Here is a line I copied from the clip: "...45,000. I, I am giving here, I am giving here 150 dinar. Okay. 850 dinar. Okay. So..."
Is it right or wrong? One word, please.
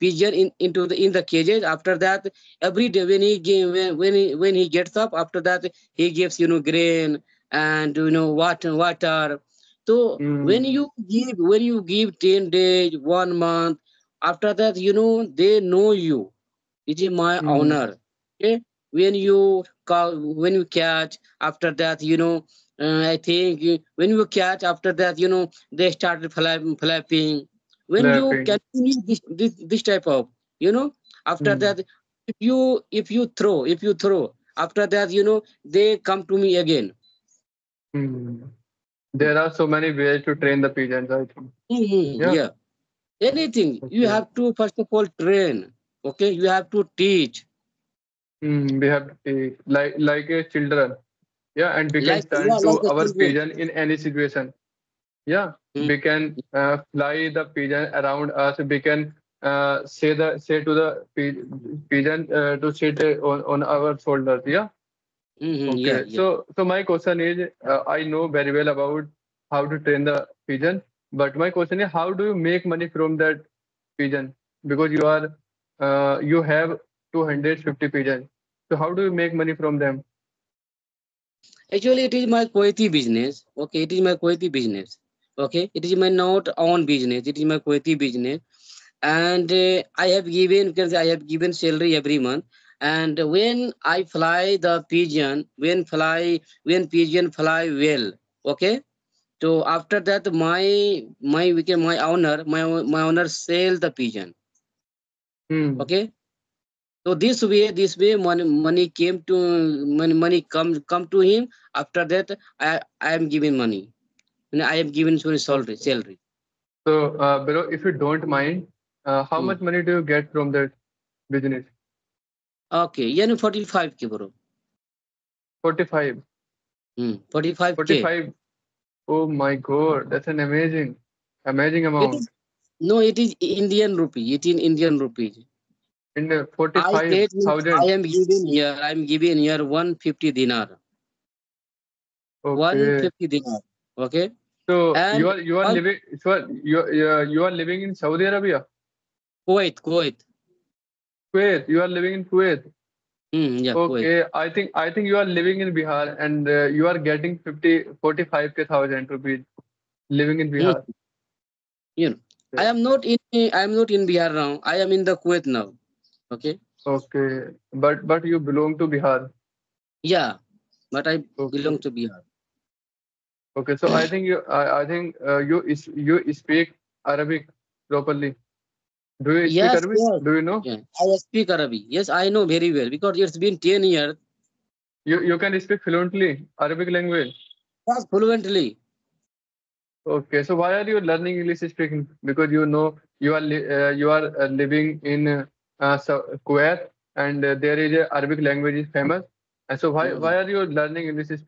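wrong.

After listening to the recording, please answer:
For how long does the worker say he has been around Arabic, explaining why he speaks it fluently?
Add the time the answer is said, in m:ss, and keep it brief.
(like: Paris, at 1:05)
10 years, at 3:03.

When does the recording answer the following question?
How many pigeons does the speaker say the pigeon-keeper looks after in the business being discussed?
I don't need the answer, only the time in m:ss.
1:17.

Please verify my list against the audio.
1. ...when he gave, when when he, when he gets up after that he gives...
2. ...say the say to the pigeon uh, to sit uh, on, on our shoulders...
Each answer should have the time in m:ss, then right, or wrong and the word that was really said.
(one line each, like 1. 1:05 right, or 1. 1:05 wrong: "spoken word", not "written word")
1. 0:03 right
2. 0:59 right.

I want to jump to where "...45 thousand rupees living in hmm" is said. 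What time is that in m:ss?
2:38.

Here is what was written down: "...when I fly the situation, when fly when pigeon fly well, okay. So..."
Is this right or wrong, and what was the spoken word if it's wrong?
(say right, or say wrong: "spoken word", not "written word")
wrong: "pigeon", not "situation".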